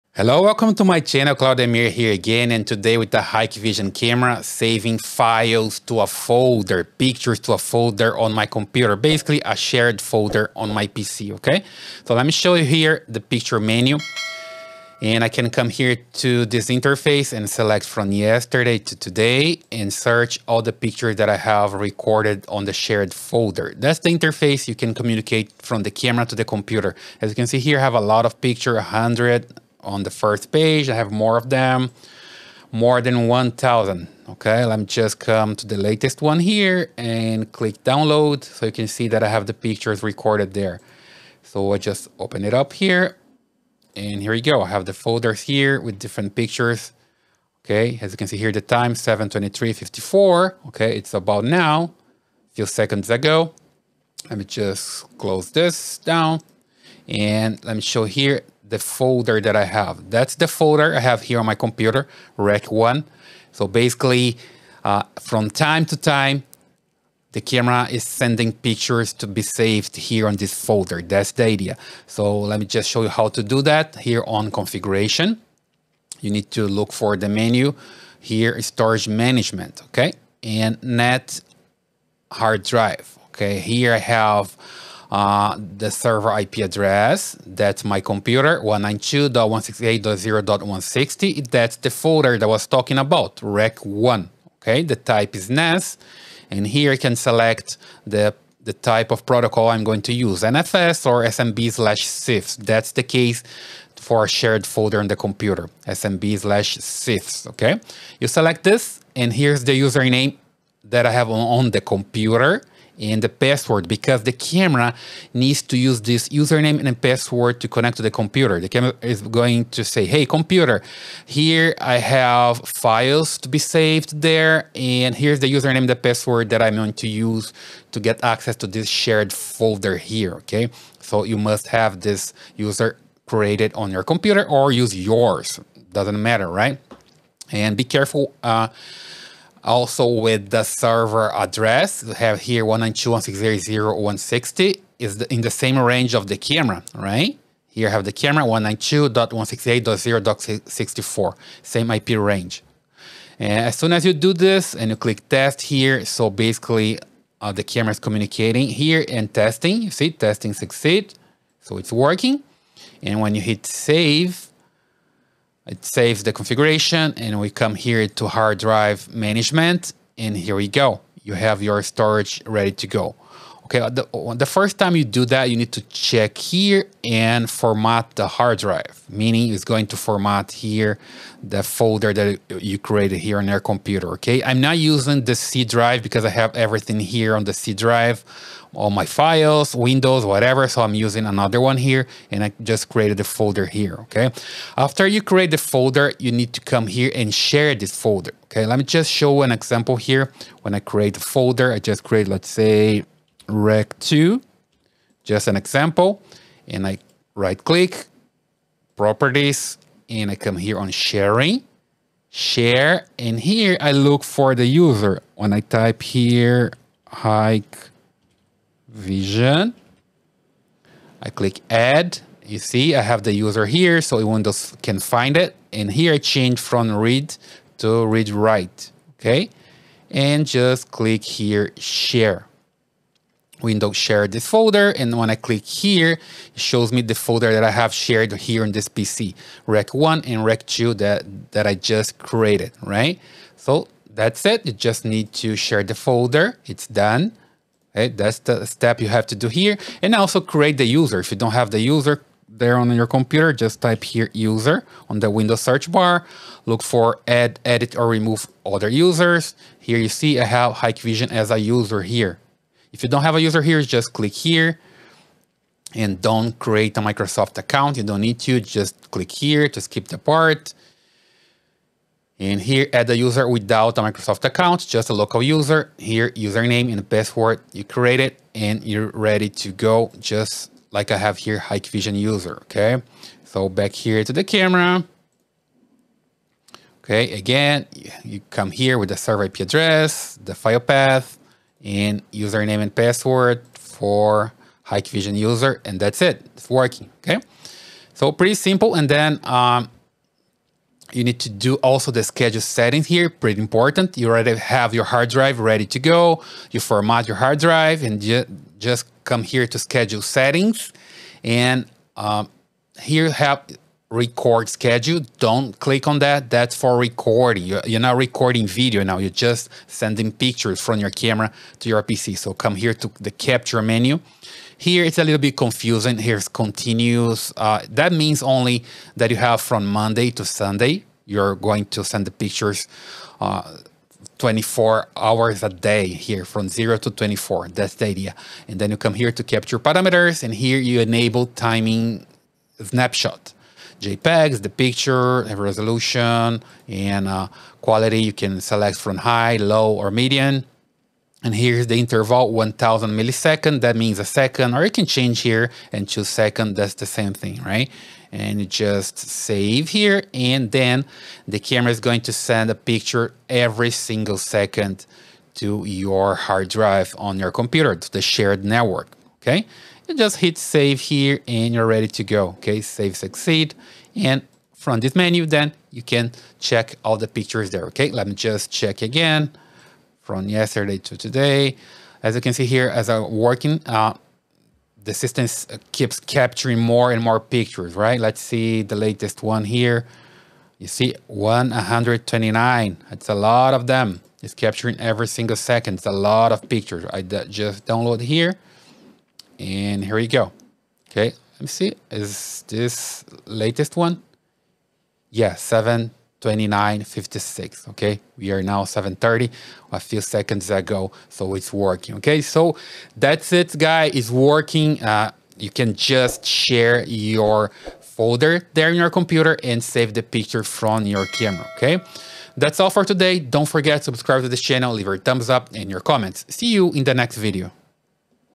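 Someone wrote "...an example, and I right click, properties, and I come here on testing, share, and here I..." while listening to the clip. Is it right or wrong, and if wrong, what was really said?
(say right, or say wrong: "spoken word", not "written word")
wrong: "sharing", not "testing".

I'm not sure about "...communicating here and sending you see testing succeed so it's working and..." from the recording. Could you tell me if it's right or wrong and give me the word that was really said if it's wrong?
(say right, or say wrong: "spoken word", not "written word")
wrong: "testing", not "sending".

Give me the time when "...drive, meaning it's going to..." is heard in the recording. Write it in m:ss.
2:58.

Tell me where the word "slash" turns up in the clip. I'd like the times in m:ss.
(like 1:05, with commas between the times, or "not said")
1:41, 1:46.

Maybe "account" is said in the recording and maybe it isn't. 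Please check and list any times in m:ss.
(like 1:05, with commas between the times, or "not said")
4:27, 4:34.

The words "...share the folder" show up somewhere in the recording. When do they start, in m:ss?
4:05.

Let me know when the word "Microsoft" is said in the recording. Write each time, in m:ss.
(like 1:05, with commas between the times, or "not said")
4:27, 4:34.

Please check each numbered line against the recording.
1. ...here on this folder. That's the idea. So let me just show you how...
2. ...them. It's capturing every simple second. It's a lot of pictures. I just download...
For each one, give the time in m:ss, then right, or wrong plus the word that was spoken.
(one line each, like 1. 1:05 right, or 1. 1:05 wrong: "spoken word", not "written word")
1. 1:09 right
2. 6:33 wrong: "single", not "simple".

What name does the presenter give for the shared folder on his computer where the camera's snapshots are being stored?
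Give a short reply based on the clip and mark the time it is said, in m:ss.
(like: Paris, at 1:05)
Rec 1, at 1:02.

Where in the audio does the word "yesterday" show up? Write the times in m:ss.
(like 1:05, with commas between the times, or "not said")
0:18, 6:20.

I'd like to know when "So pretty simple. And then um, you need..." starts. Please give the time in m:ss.
4:58.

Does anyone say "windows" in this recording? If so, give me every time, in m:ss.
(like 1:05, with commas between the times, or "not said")
3:09, 3:44, 3:53, 4:15.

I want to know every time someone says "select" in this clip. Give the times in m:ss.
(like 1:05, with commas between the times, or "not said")
0:17, 1:37, 1:48, 5:48.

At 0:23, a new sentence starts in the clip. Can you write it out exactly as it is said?
That's the interface you can communicate from the camera to the computer.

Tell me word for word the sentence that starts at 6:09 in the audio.
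Okay just hit save here and you're ready to go.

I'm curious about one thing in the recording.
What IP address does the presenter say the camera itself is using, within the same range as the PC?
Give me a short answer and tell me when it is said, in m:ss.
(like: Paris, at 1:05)
192.168.0.64, at 2:28.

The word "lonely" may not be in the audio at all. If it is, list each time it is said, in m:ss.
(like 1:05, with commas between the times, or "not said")
not said.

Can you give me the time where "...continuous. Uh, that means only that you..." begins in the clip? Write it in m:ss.
5:26.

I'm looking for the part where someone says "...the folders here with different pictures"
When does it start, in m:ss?
0:44.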